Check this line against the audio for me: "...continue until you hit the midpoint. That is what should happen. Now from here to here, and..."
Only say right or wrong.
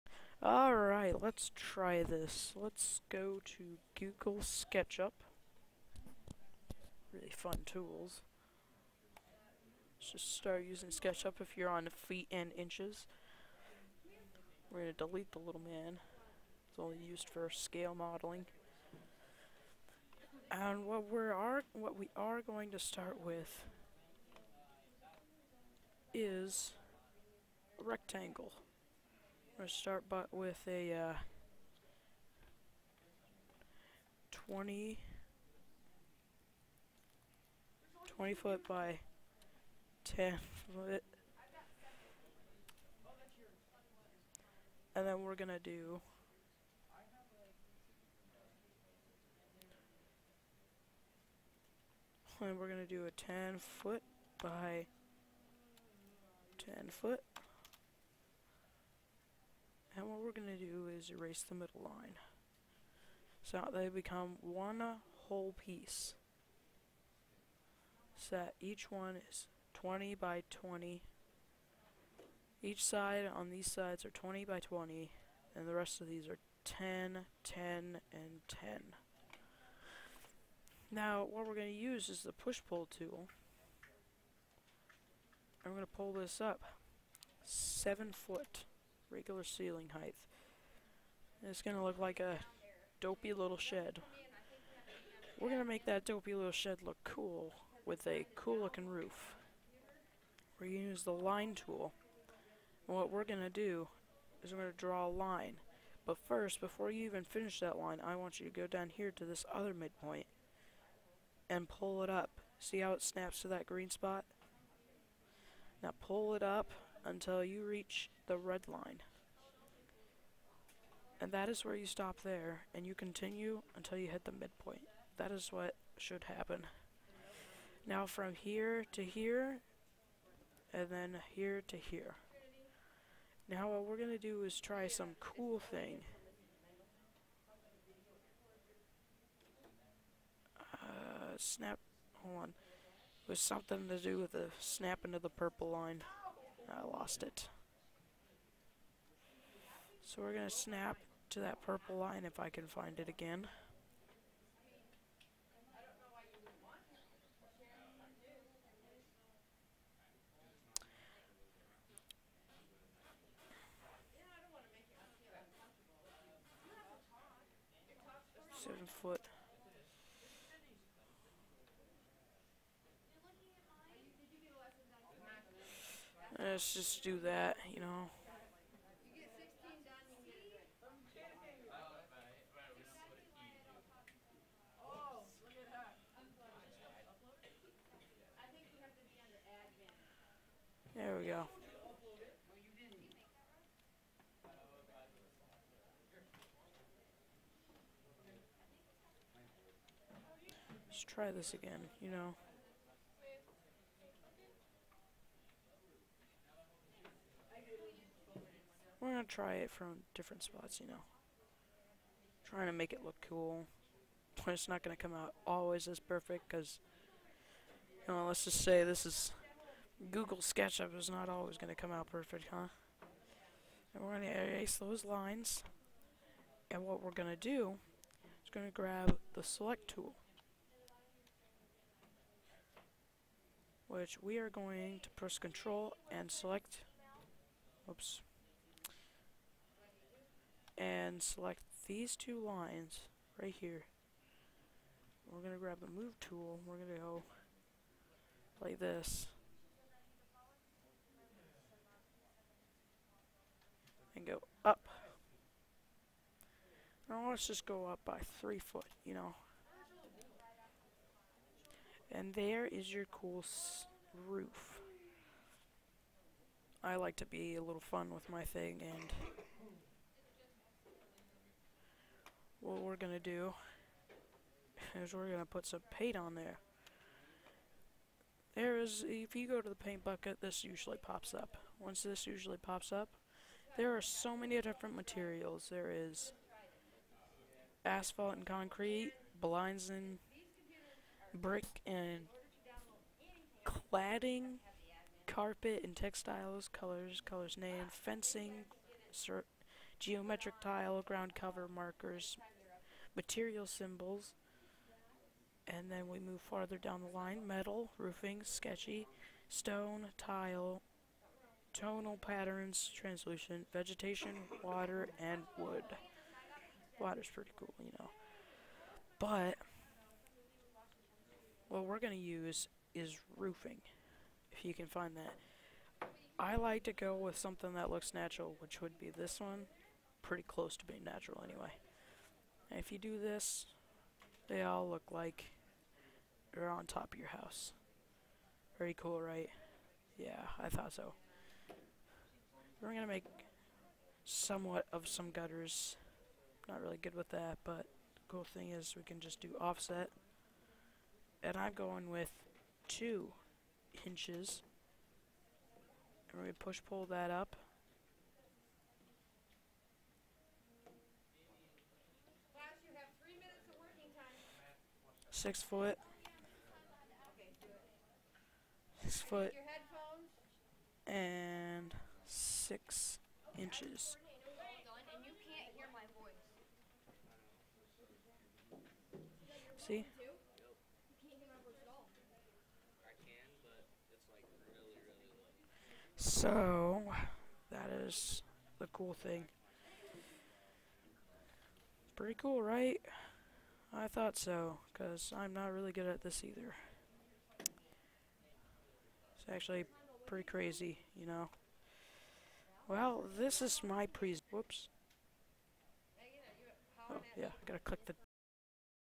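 right.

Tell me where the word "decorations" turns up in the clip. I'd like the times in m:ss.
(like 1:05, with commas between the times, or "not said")
not said.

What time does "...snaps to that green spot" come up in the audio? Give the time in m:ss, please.
1:53.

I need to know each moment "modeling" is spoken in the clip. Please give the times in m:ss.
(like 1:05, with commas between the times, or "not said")
0:17.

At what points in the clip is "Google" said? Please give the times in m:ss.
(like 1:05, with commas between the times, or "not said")
0:03, 3:40.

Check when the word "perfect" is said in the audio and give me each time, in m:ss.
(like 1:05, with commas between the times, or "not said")
3:35, 3:42.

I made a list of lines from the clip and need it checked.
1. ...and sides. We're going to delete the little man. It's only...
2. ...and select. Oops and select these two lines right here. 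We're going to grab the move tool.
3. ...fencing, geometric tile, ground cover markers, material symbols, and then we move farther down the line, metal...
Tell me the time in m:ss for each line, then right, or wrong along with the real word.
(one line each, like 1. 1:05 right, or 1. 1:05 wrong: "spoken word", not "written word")
1. 0:12 wrong: "inches", not "sides"
2. 3:56 right
3. 4:57 right.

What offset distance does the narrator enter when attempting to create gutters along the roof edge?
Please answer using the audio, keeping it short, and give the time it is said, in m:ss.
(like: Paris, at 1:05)
2 inches, at 5:52.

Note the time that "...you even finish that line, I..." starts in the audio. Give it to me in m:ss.
1:46.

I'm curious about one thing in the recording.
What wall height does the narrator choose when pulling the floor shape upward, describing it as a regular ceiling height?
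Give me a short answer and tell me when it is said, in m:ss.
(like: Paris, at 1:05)
7 foot, at 1:27.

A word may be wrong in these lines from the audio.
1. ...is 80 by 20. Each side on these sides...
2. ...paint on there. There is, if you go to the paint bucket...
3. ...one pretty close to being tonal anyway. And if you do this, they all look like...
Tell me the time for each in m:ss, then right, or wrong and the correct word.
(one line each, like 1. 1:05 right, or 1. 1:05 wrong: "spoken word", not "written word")
1. 1:09 wrong: "20", not "80"
2. 4:35 right
3. 5:29 wrong: "natural", not "tonal".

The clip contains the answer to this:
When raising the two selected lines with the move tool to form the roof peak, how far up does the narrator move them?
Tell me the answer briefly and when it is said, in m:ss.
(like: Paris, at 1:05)
3 foot, at 4:18.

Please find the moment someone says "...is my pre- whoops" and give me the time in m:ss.
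6:43.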